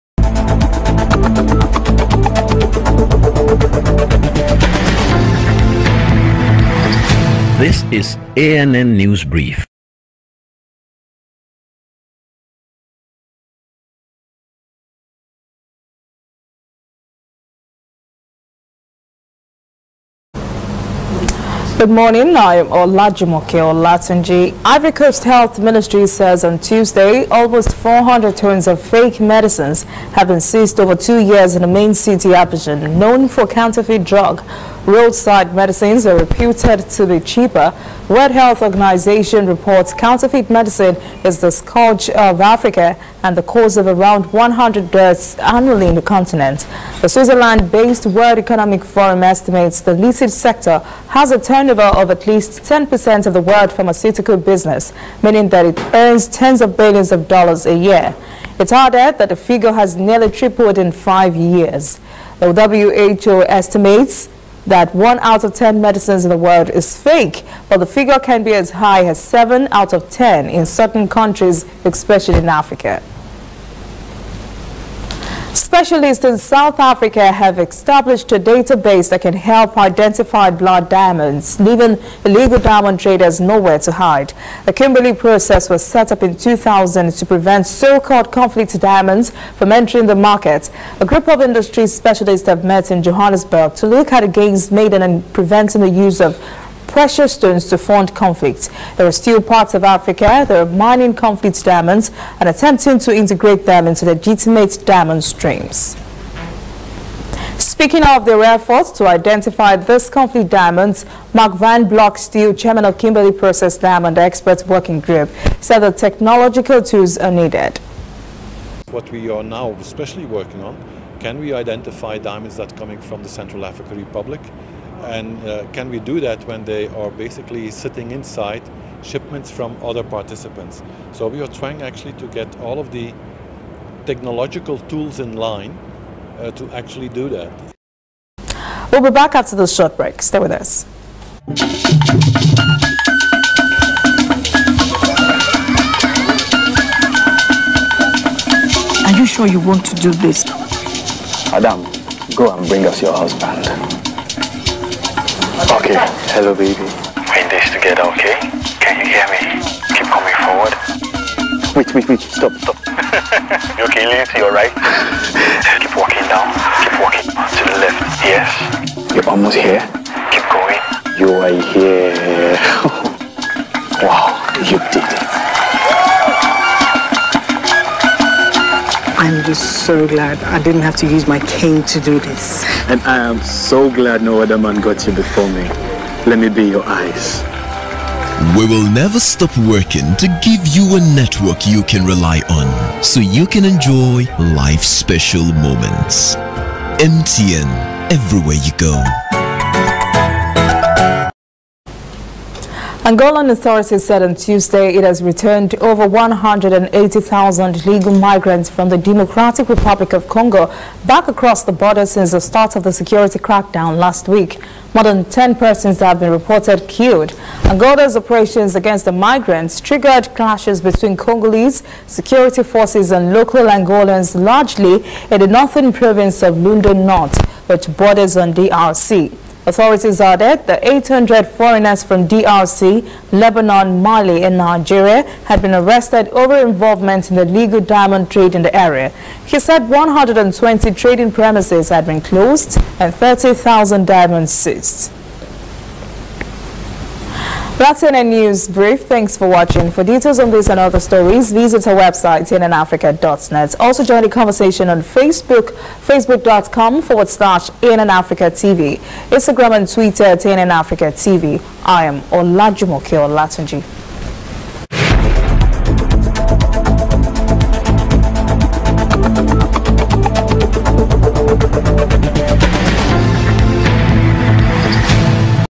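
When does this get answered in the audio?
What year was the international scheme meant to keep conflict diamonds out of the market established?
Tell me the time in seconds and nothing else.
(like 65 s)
86 s.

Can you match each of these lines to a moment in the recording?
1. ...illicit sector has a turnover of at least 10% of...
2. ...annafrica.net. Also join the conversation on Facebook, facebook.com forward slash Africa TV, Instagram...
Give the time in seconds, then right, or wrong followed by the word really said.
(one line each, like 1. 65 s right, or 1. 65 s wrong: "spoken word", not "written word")
1. 49 s right
2. 252 s right.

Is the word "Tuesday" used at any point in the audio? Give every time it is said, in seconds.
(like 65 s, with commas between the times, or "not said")
26 s, 204 s.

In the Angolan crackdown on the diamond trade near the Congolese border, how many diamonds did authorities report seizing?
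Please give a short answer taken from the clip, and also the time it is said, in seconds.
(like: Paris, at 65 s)
30,000, at 243 s.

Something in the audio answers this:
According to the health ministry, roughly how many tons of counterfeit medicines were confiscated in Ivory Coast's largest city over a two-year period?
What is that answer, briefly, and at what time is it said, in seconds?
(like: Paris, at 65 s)
400 tons, at 27 s.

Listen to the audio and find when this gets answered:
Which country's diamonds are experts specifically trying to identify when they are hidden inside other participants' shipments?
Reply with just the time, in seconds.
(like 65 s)
123 s.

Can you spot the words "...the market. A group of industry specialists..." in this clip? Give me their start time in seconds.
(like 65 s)
90 s.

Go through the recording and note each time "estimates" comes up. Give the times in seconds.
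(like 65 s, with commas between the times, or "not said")
49 s, 63 s.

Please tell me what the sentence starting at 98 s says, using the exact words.
There are still parts of Africa that are mining conflict diamonds and attempting to integrate them into legitimate diamond streams.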